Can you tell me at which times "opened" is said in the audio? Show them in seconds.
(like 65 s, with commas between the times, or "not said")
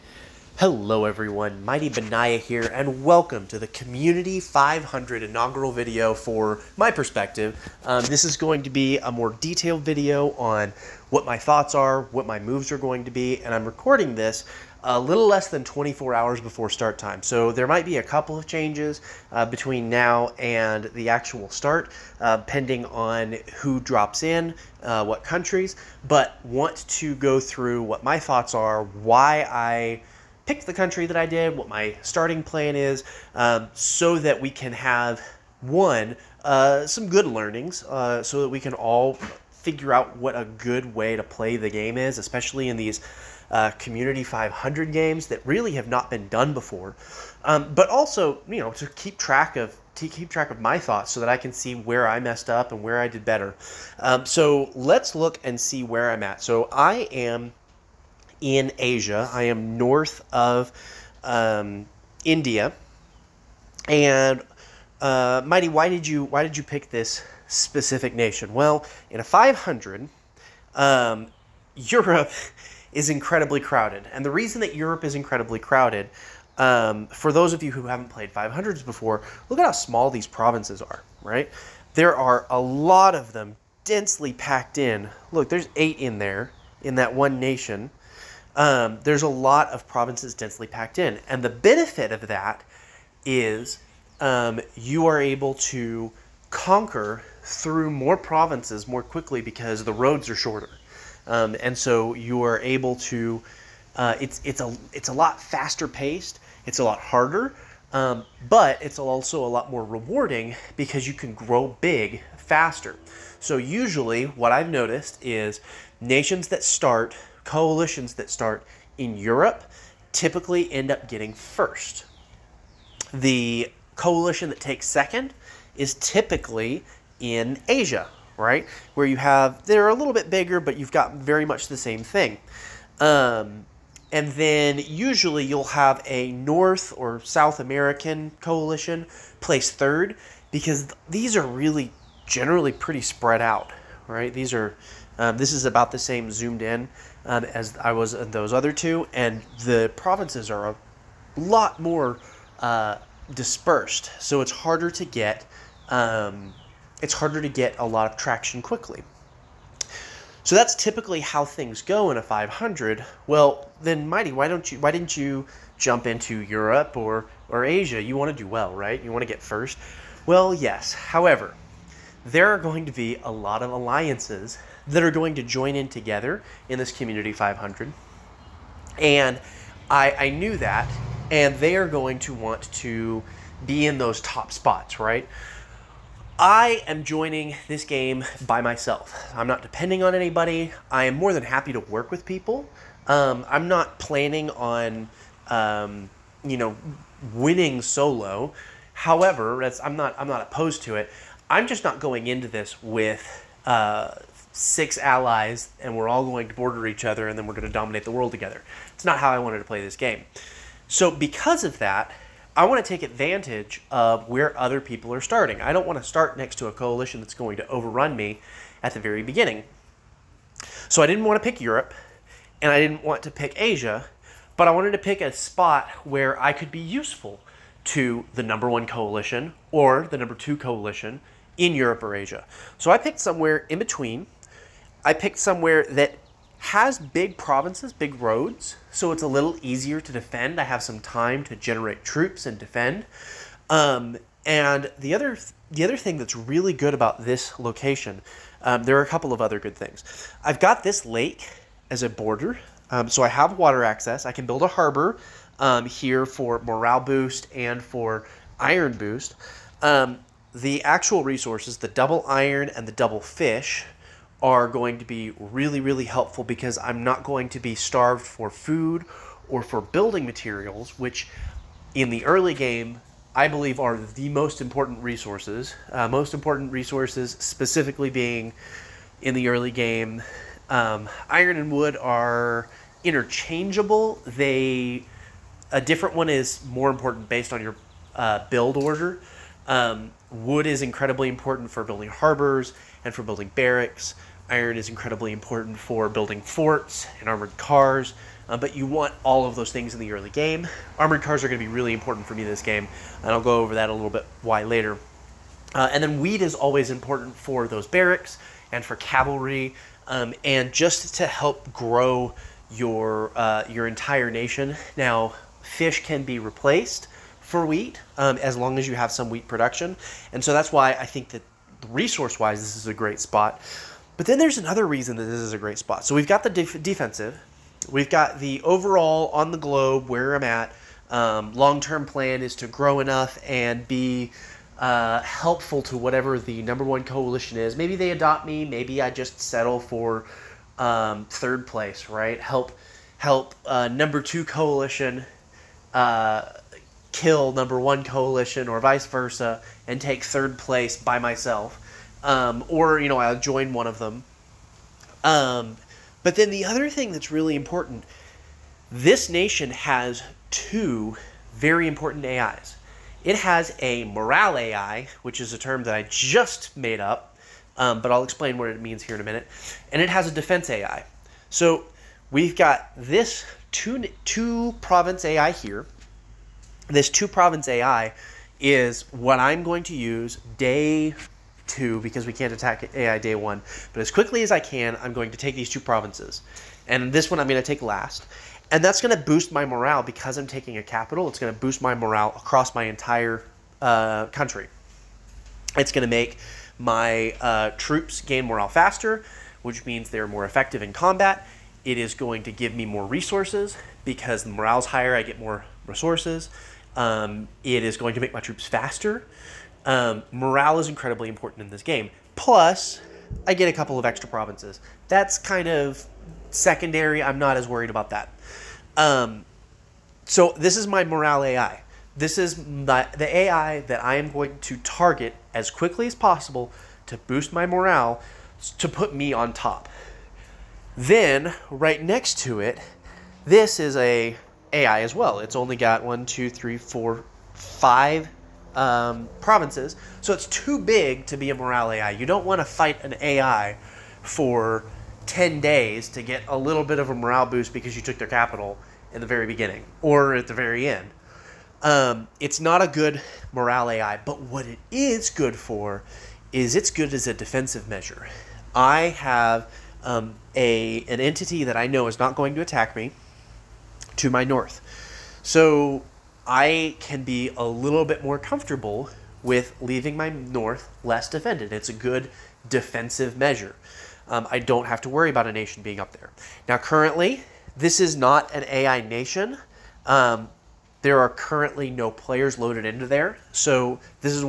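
not said.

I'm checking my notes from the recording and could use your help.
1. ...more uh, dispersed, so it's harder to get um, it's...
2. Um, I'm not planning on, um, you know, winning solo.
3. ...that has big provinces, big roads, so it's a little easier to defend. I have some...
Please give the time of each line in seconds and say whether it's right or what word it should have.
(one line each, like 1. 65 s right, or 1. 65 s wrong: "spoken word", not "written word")
1. 151 s right
2. 193 s right
3. 235 s right.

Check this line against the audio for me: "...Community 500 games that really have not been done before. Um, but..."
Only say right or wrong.
right.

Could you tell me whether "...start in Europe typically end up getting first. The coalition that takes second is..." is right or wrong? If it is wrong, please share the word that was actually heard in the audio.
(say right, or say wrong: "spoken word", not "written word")
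right.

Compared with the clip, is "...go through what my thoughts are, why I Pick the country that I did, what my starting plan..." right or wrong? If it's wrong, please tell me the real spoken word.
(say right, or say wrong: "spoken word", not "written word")
right.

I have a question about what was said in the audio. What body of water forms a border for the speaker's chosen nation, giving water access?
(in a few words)
lake.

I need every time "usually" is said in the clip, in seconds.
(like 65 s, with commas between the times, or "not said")
113 s, 134 s.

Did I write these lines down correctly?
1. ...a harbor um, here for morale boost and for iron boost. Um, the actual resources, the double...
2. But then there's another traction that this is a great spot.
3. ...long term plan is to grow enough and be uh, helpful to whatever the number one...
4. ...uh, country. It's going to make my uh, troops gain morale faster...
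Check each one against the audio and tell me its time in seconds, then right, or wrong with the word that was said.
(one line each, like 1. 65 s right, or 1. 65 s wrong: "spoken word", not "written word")
1. 254 s right
2. 324 s wrong: "reason", not "traction"
3. 331 s right
4. 393 s right.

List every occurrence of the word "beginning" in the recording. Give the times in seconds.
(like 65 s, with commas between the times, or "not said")
219 s, 449 s.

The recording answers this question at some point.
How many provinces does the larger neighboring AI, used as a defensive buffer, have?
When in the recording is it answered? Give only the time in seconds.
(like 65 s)
437 s.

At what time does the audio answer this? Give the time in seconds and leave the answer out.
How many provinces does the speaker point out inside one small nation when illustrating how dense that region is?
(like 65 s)
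85 s.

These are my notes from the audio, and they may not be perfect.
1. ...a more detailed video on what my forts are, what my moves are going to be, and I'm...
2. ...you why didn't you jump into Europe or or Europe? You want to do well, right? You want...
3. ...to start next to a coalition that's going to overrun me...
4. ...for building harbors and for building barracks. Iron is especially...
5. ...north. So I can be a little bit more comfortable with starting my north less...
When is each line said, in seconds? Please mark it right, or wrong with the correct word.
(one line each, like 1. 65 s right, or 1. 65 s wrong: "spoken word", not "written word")
1. 8 s wrong: "thoughts", not "forts"
2. 164 s wrong: "Asia", not "Europe"
3. 215 s right
4. 291 s wrong: "incredibly", not "especially"
5. 464 s wrong: "leaving", not "starting".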